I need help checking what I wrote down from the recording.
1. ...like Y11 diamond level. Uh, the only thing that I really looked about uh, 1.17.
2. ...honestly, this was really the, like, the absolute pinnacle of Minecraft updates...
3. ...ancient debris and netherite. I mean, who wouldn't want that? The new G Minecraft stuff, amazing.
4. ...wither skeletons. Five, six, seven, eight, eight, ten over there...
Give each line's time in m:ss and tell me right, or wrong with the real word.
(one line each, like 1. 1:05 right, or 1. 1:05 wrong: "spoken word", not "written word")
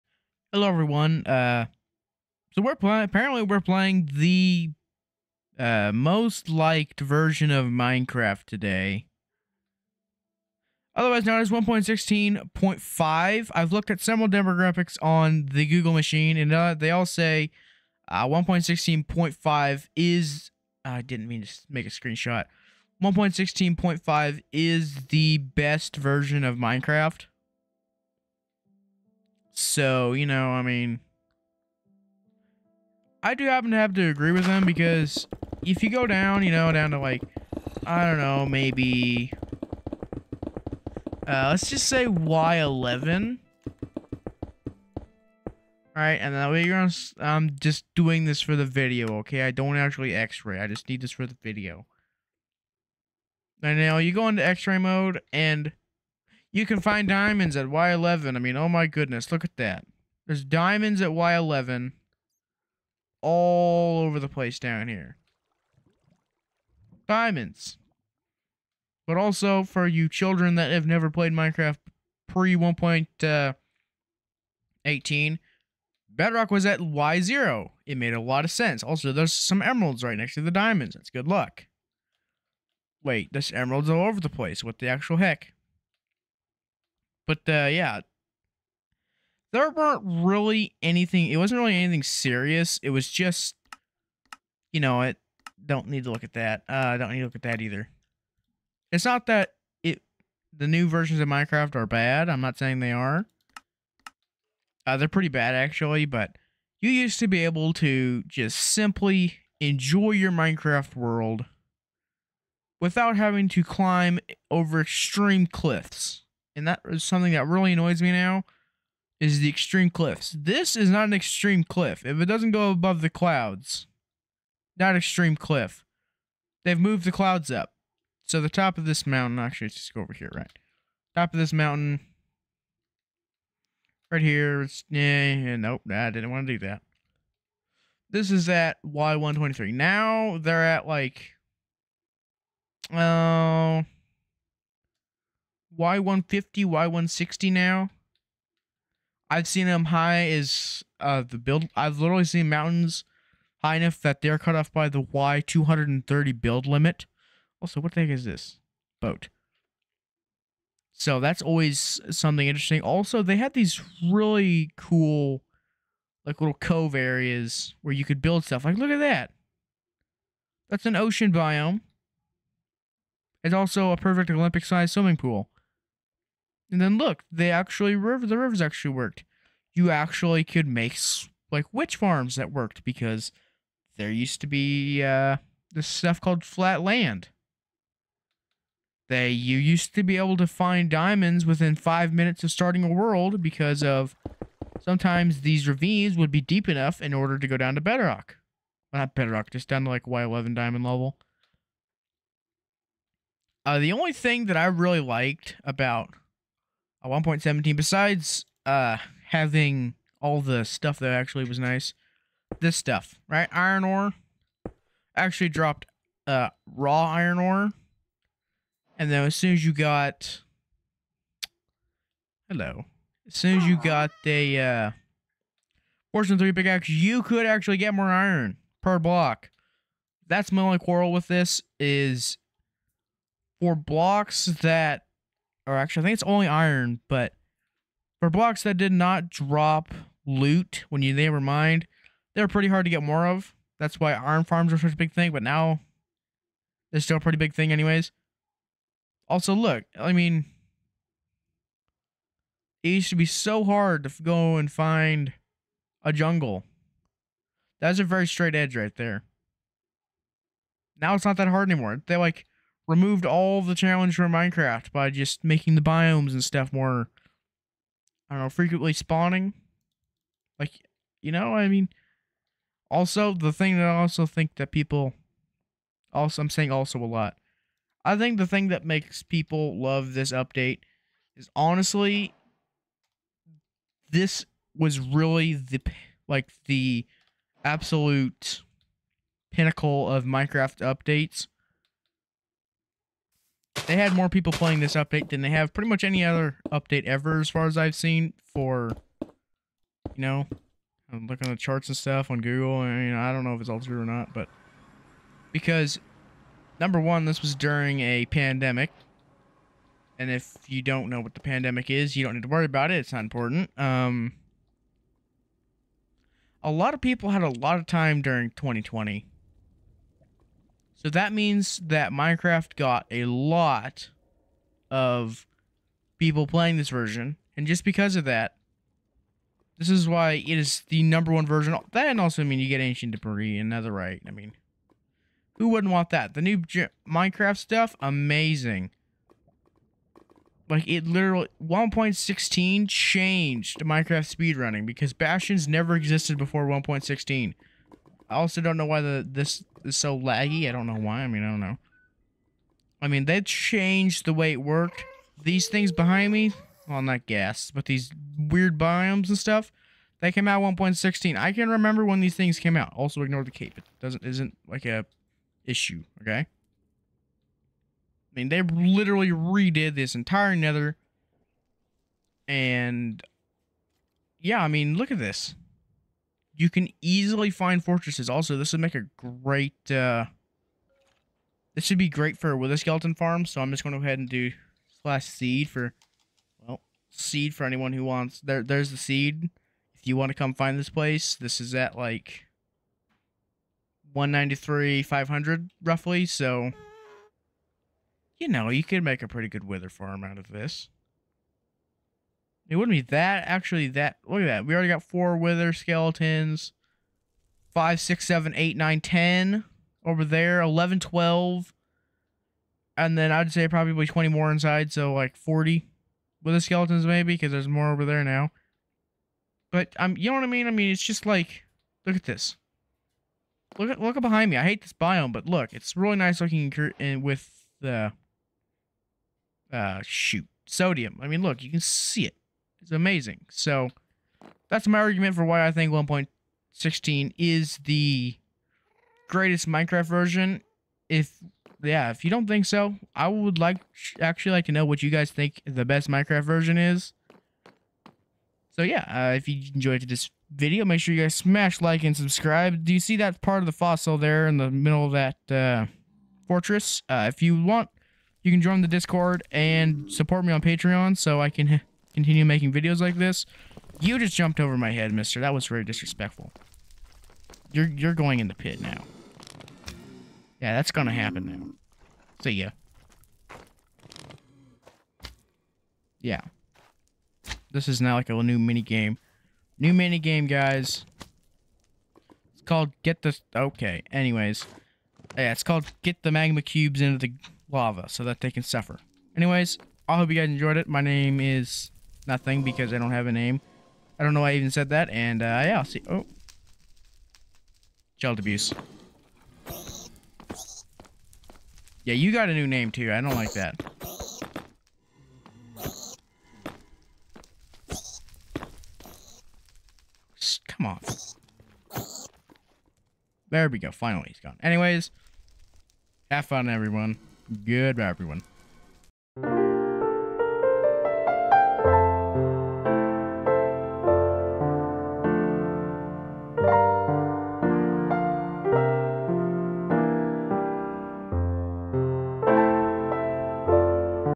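1. 3:19 wrong: "liked", not "looked"
2. 4:41 right
3. 5:32 right
4. 6:45 wrong: "nine", not "eight".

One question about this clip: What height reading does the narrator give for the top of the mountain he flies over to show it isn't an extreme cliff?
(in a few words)
Y123.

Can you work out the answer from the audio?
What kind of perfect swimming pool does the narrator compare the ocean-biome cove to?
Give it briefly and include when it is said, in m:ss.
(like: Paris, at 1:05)
Olympic sized, at 2:54.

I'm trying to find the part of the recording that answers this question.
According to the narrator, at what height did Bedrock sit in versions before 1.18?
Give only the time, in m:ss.
1:16.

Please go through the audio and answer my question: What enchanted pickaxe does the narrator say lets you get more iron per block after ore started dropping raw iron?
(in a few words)
Fortune 3.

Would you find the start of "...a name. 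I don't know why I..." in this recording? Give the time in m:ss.
8:13.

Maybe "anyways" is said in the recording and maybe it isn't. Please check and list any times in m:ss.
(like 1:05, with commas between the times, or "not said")
4:07, 8:04, 8:09, 8:34.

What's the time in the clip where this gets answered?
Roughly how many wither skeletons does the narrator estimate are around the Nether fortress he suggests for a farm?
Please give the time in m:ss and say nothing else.
6:55.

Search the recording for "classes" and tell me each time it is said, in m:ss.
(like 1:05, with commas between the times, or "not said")
not said.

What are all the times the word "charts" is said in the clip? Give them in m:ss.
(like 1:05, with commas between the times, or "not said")
5:01.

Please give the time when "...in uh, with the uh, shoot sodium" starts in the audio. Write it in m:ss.
7:06.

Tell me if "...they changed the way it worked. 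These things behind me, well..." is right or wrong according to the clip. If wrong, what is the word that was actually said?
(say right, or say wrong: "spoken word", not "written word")
right.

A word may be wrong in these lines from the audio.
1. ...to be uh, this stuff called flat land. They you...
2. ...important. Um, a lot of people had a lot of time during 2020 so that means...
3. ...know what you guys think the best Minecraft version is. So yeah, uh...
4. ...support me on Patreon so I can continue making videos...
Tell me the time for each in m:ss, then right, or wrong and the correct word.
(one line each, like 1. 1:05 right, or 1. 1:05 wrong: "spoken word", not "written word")
1. 3:04 right
2. 5:13 right
3. 7:24 right
4. 7:40 right.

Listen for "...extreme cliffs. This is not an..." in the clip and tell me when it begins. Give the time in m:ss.
1:59.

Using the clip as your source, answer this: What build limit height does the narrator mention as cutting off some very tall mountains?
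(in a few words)
Y230.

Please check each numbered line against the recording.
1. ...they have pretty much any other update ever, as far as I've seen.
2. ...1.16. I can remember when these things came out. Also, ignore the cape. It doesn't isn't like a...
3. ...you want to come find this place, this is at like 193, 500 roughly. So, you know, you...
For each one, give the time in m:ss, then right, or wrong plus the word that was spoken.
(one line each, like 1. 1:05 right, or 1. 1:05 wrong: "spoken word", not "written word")
1. 4:55 right
2. 6:00 right
3. 6:30 right.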